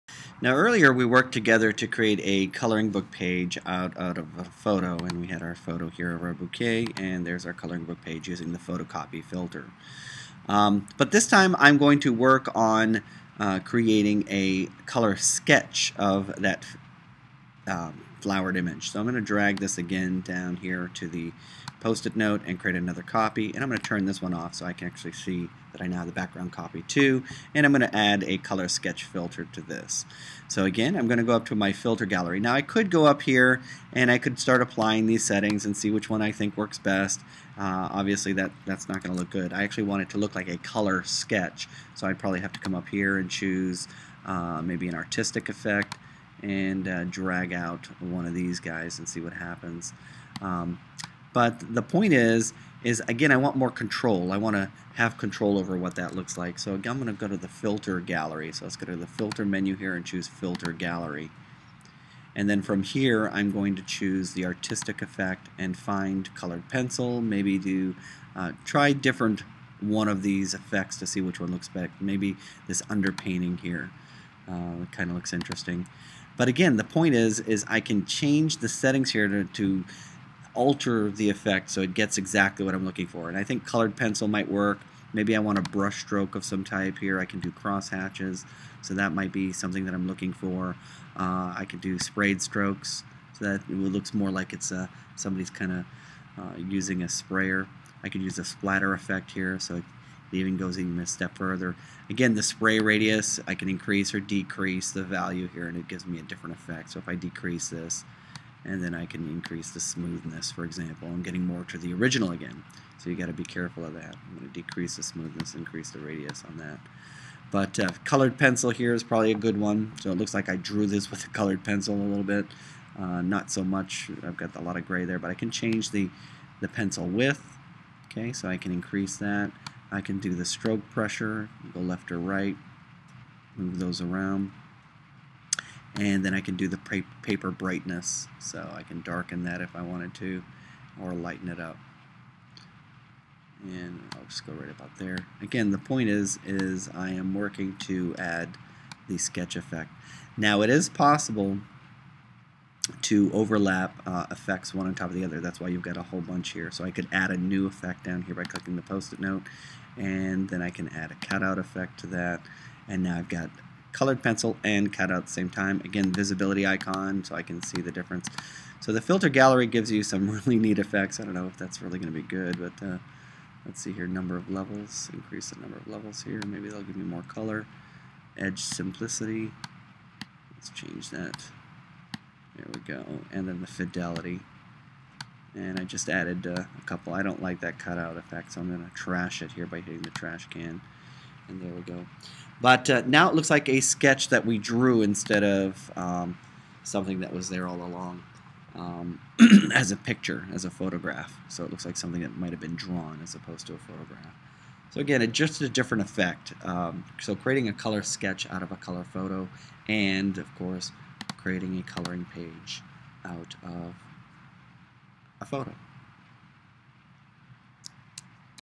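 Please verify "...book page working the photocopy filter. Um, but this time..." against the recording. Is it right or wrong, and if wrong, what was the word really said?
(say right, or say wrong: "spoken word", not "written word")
wrong: "using", not "working".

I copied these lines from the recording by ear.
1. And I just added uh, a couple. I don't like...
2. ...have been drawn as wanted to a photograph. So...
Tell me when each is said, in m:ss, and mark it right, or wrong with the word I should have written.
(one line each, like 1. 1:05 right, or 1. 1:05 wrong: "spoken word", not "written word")
1. 3:05 right
2. 3:22 wrong: "opposed", not "wanted".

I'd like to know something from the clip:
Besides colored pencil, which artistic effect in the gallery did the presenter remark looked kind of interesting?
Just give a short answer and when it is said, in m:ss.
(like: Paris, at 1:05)
Underpainting, at 1:12.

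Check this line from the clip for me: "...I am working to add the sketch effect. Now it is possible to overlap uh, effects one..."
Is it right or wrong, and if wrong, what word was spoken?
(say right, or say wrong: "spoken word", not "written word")
right.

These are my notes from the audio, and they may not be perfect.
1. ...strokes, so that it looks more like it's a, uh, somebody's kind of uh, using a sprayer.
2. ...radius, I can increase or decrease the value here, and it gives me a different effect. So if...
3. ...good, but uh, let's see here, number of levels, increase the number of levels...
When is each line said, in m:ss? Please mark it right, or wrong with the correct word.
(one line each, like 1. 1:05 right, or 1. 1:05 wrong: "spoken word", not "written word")
1. 1:32 right
2. 1:42 right
3. 2:52 right.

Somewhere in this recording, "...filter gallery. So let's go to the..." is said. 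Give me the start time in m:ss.
0:57.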